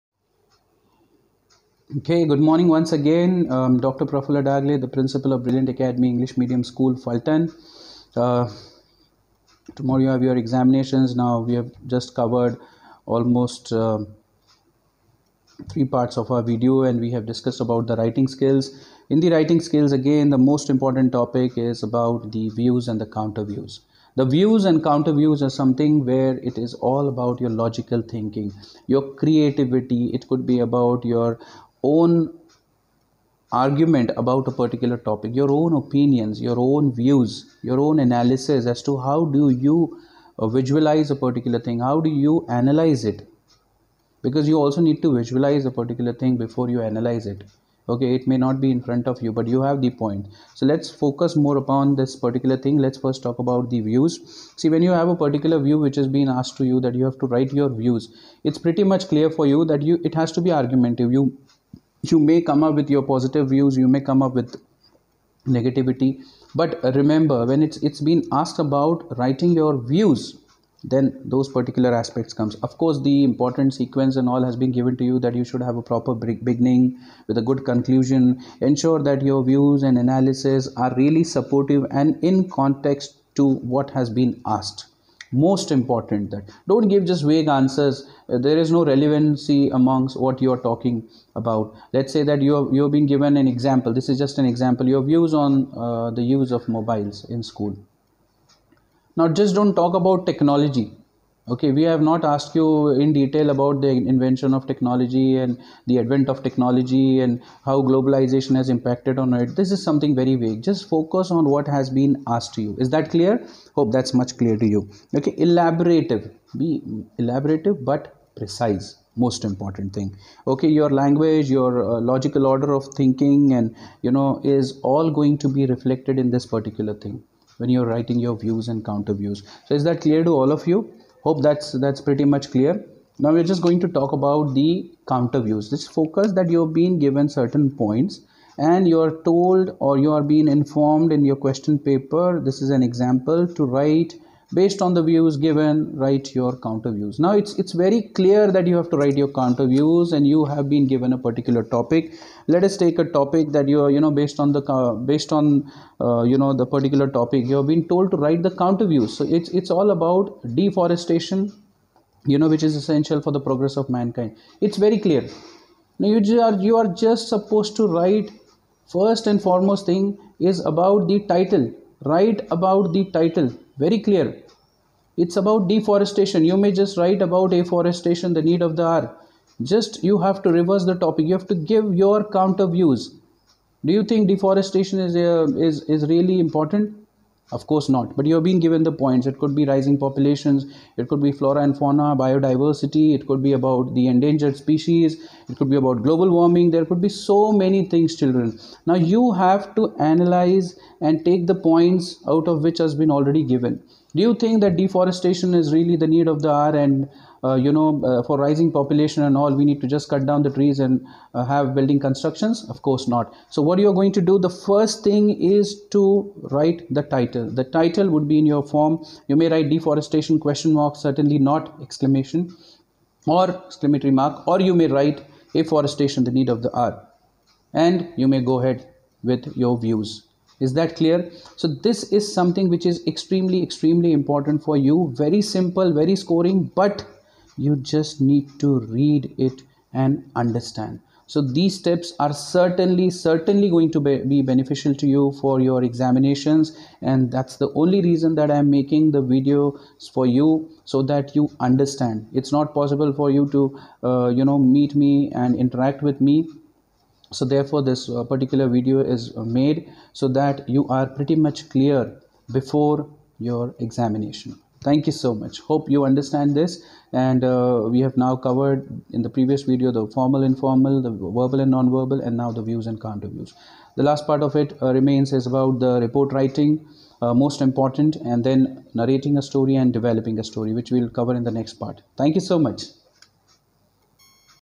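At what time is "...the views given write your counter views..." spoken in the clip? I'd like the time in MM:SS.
02:24.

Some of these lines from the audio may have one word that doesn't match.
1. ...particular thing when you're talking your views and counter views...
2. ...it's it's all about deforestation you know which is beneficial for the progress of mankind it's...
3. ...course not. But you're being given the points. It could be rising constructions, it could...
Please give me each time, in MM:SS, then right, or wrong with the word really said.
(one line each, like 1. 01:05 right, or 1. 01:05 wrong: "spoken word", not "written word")
1. 02:06 wrong: "writing", not "talking"
2. 02:39 wrong: "essential", not "beneficial"
3. 03:07 wrong: "populations", not "constructions".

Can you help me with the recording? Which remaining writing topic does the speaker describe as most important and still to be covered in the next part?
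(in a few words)
Report writing.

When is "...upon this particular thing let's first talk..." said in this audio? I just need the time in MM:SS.
00:51.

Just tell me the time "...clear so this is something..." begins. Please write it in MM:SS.
03:51.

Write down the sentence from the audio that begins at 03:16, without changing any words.
There could be so many things, children.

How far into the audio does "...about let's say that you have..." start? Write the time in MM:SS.
01:31.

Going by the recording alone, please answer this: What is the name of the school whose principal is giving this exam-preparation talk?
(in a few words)
Brilliant Academy English Medium School.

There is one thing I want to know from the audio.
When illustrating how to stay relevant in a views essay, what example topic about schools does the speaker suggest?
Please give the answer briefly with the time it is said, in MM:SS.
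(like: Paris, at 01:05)
use of mobiles in school, at 01:36.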